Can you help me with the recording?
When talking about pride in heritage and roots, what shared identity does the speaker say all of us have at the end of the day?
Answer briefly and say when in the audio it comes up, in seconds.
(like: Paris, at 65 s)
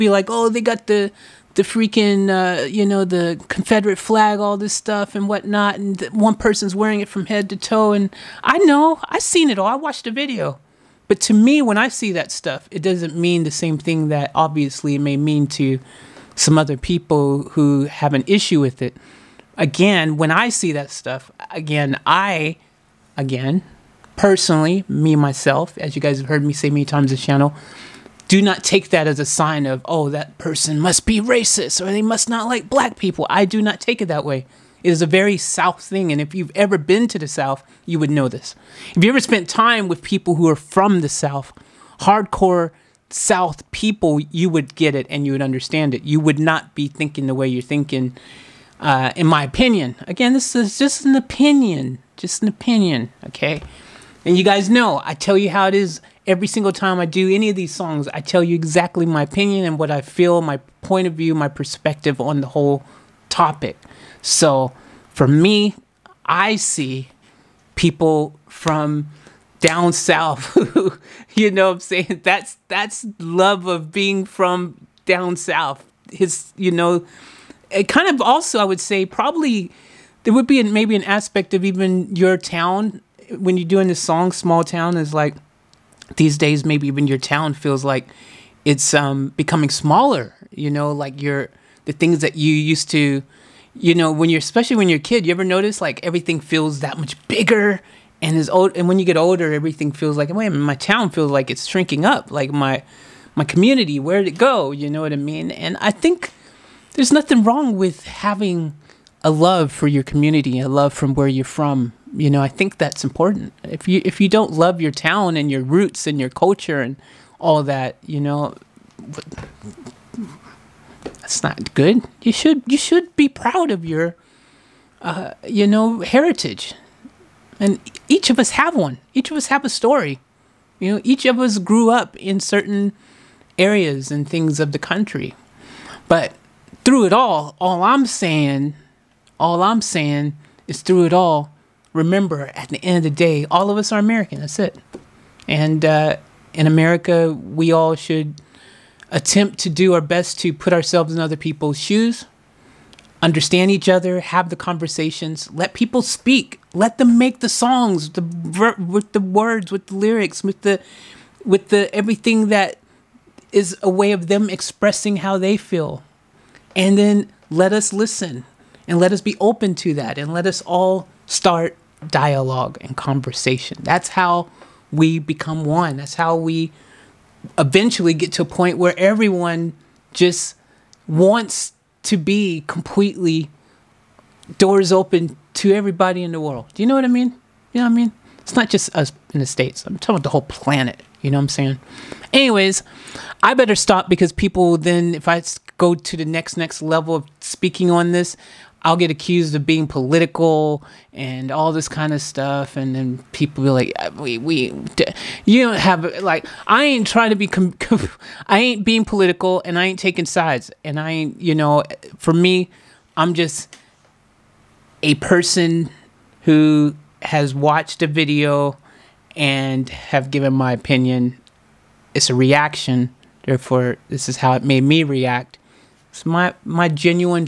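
American, at 143 s.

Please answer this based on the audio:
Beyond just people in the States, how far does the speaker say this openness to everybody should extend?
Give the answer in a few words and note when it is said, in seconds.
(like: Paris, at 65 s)
The whole planet, at 190 s.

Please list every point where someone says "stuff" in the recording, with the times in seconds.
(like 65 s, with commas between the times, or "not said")
4 s, 12 s, 20 s, 202 s.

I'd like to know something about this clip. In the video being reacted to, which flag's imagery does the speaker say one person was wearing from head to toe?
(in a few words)
Confederate flag.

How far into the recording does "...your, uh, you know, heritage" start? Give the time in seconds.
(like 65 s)
123 s.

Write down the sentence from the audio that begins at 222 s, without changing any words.
It's a reaction, therefore, this is how it made me react.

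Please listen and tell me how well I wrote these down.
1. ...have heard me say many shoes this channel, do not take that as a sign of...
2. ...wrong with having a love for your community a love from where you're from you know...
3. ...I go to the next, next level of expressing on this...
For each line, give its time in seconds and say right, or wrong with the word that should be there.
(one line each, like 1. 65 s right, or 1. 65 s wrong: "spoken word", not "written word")
1. 26 s wrong: "times", not "shoes"
2. 107 s right
3. 195 s wrong: "speaking", not "expressing".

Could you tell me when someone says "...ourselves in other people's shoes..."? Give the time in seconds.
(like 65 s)
150 s.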